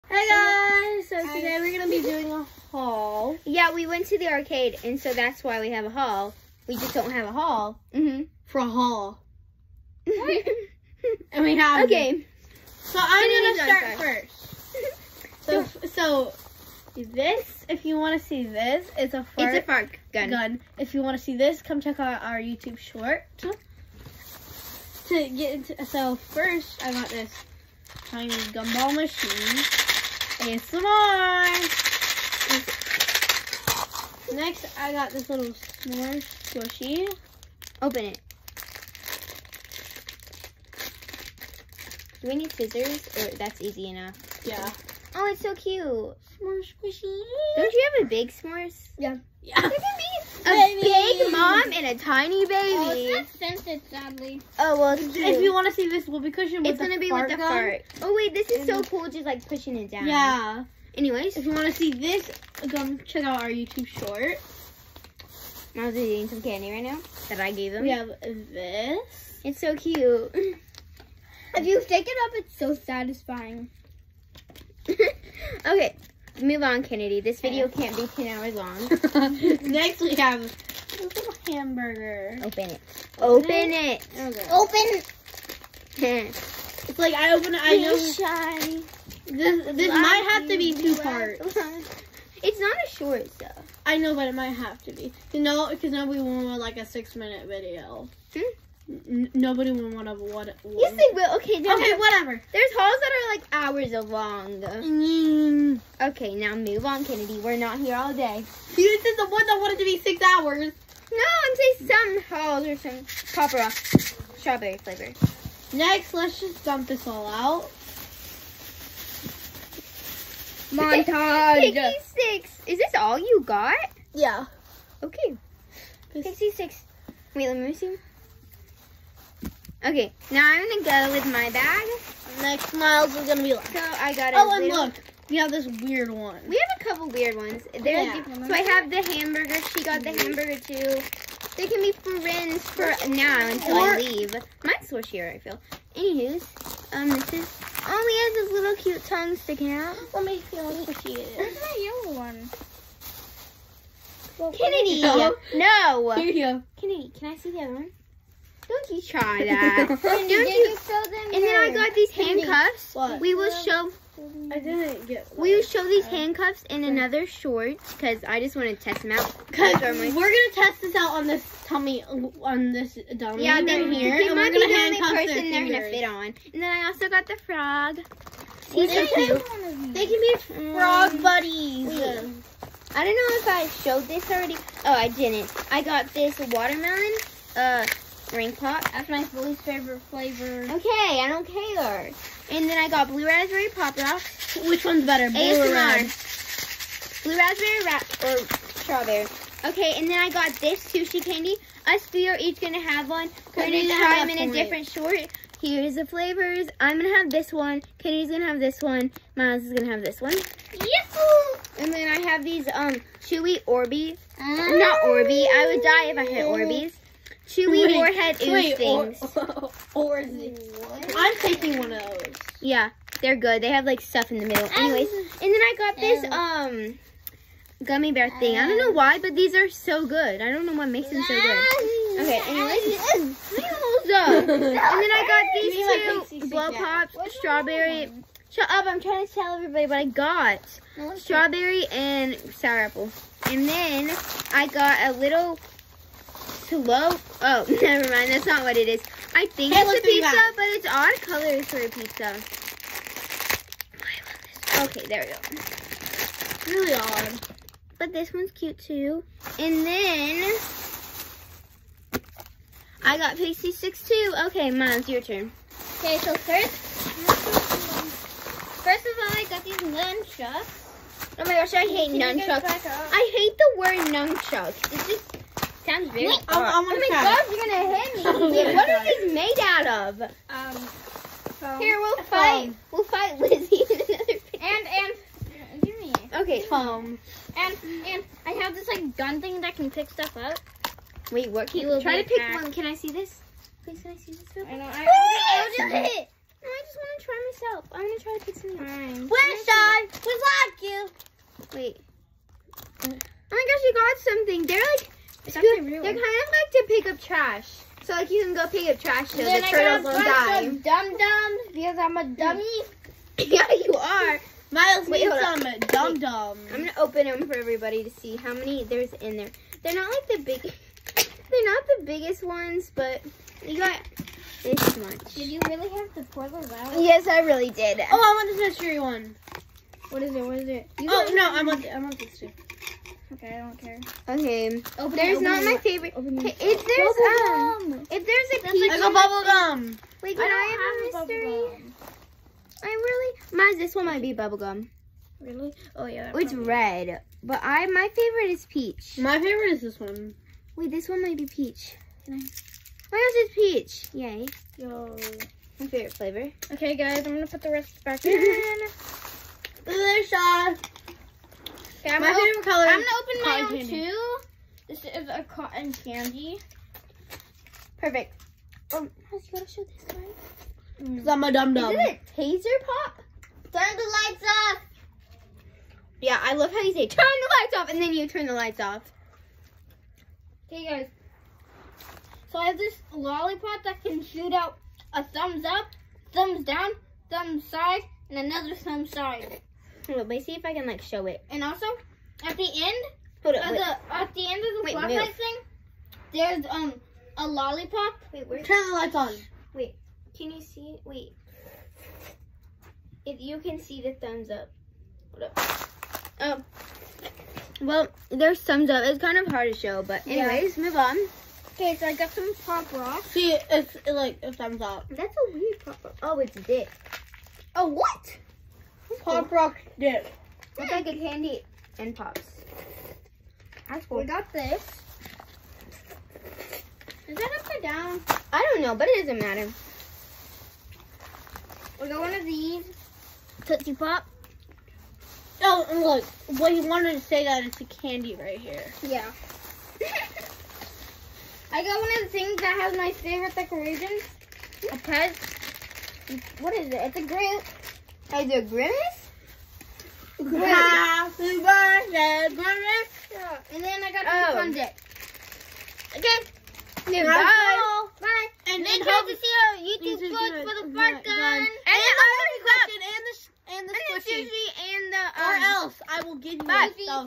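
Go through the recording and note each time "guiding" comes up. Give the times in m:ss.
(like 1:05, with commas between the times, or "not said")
not said.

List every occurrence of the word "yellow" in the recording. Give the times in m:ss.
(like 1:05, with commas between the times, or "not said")
2:32.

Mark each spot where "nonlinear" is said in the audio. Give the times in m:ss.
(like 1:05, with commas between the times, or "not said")
not said.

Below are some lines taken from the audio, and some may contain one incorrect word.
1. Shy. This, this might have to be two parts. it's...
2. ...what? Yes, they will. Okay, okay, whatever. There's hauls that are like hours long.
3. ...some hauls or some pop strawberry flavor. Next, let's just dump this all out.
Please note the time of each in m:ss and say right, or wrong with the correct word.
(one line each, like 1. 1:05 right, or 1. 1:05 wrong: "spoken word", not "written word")
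1. 1:27 right
2. 1:40 right
3. 1:52 right.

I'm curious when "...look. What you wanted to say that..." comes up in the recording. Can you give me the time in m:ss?
7:15.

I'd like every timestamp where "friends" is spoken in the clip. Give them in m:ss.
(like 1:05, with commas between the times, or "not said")
2:22.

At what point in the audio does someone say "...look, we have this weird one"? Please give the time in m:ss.
2:14.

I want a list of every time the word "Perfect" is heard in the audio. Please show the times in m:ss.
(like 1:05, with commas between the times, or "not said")
6:07.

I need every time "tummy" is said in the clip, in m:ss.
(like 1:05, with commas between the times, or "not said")
2:51.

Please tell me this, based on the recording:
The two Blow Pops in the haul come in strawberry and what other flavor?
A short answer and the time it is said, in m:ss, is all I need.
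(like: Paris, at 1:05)
sour apple, at 4:02.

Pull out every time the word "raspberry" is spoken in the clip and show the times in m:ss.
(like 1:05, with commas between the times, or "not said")
3:13, 3:17.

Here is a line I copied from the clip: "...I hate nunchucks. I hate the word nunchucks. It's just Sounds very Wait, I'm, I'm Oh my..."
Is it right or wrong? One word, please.
right.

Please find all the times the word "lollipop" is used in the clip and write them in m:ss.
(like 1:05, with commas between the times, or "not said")
6:23, 6:37.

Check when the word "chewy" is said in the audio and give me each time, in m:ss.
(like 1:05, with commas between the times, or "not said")
3:33, 3:37.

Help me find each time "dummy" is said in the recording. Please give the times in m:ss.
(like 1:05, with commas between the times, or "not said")
2:53, 5:12.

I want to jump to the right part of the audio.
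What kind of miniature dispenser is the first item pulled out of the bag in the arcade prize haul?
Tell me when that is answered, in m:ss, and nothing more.
0:28.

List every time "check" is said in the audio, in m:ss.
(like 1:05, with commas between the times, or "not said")
0:21, 1:03.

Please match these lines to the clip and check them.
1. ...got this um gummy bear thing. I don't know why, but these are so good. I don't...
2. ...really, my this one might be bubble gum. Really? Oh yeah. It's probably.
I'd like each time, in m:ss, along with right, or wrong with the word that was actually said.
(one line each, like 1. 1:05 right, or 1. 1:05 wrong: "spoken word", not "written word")
1. 3:45 right
2. 5:42 right.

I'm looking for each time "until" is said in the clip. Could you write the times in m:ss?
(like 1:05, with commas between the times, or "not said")
2:23.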